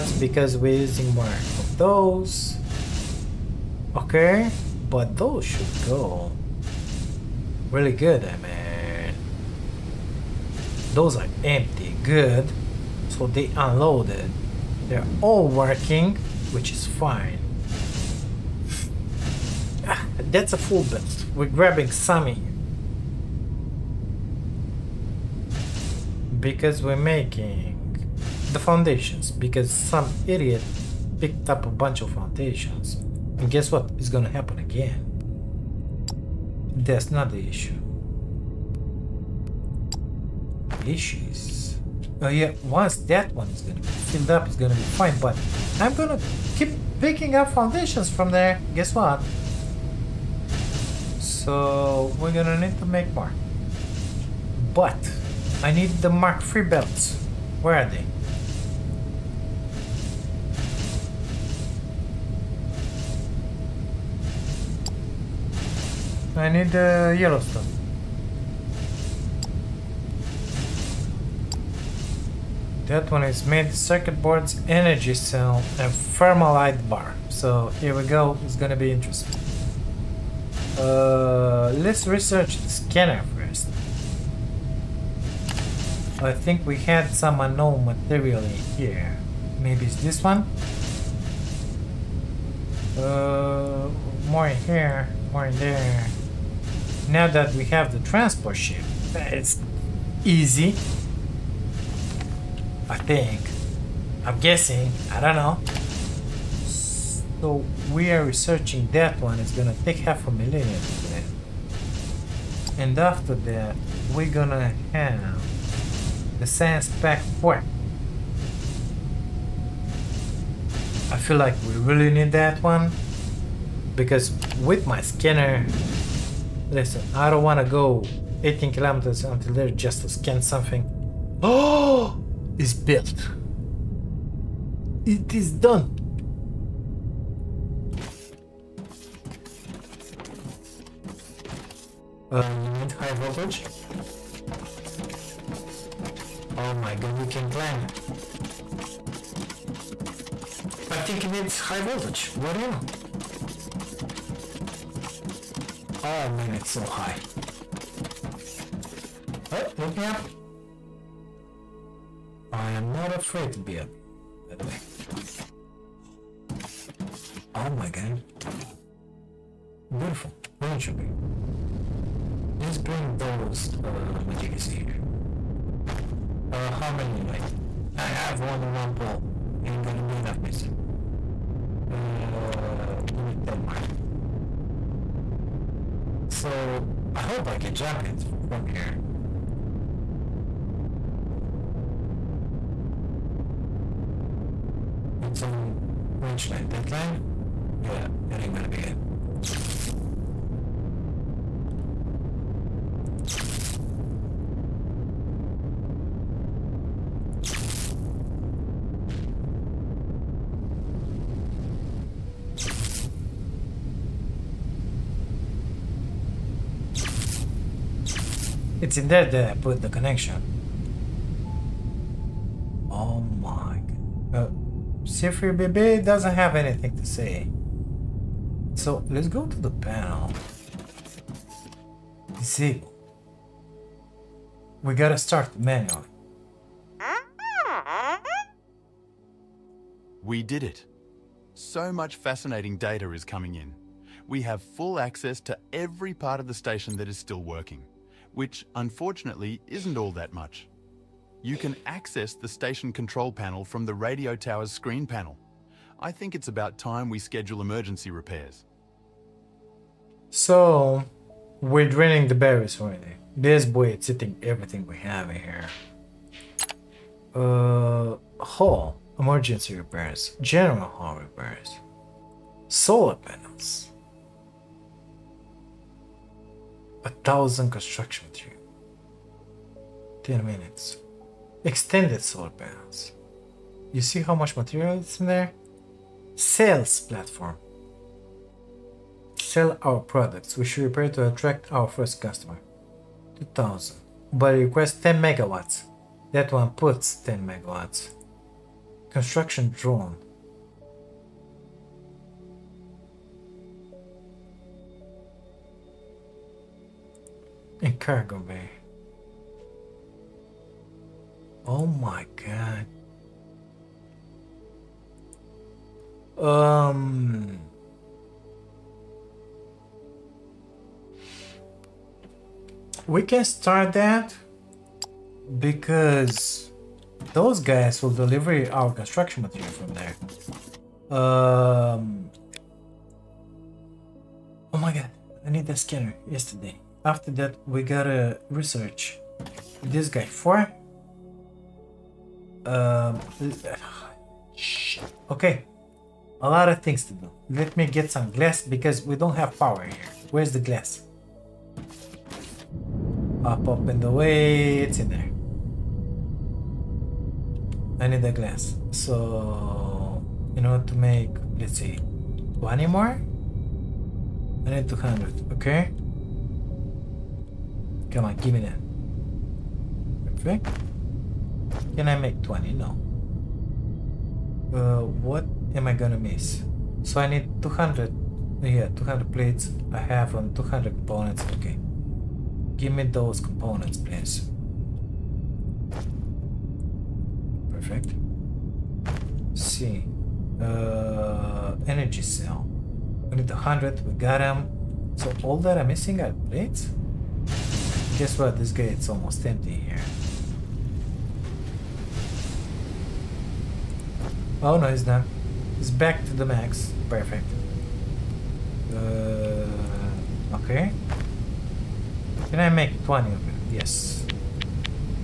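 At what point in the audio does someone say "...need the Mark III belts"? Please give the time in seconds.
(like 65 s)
55 s.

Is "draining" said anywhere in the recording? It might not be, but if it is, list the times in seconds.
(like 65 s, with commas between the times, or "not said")
261 s.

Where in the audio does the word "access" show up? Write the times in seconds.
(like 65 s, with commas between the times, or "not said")
244 s, 251 s.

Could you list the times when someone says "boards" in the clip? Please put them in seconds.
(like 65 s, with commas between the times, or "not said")
74 s.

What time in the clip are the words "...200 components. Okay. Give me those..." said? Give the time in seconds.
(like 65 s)
380 s.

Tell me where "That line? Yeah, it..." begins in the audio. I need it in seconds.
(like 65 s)
196 s.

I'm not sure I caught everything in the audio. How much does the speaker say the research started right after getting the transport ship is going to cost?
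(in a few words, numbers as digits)
half a million.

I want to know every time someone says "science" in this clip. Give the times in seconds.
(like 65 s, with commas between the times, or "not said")
116 s.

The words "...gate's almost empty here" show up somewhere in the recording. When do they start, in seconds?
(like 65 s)
398 s.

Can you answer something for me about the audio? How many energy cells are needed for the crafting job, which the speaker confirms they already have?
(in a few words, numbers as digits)
100.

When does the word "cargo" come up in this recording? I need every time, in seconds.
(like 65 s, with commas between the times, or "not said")
307 s.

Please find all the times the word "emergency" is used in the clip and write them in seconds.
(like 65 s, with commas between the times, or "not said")
257 s, 269 s.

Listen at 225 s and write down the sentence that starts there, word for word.
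Jeffrey, Bebe doesn't have anything to say.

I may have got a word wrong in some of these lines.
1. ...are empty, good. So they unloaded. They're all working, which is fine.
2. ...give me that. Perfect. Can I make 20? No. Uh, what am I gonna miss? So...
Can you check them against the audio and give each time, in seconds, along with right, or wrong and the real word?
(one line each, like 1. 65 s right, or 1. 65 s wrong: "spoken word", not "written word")
1. 11 s right
2. 368 s right.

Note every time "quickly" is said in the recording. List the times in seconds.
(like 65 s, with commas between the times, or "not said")
not said.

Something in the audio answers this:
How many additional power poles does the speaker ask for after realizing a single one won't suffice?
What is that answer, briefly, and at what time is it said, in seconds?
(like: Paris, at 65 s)
10, at 183 s.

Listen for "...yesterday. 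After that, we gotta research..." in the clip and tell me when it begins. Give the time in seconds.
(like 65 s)
336 s.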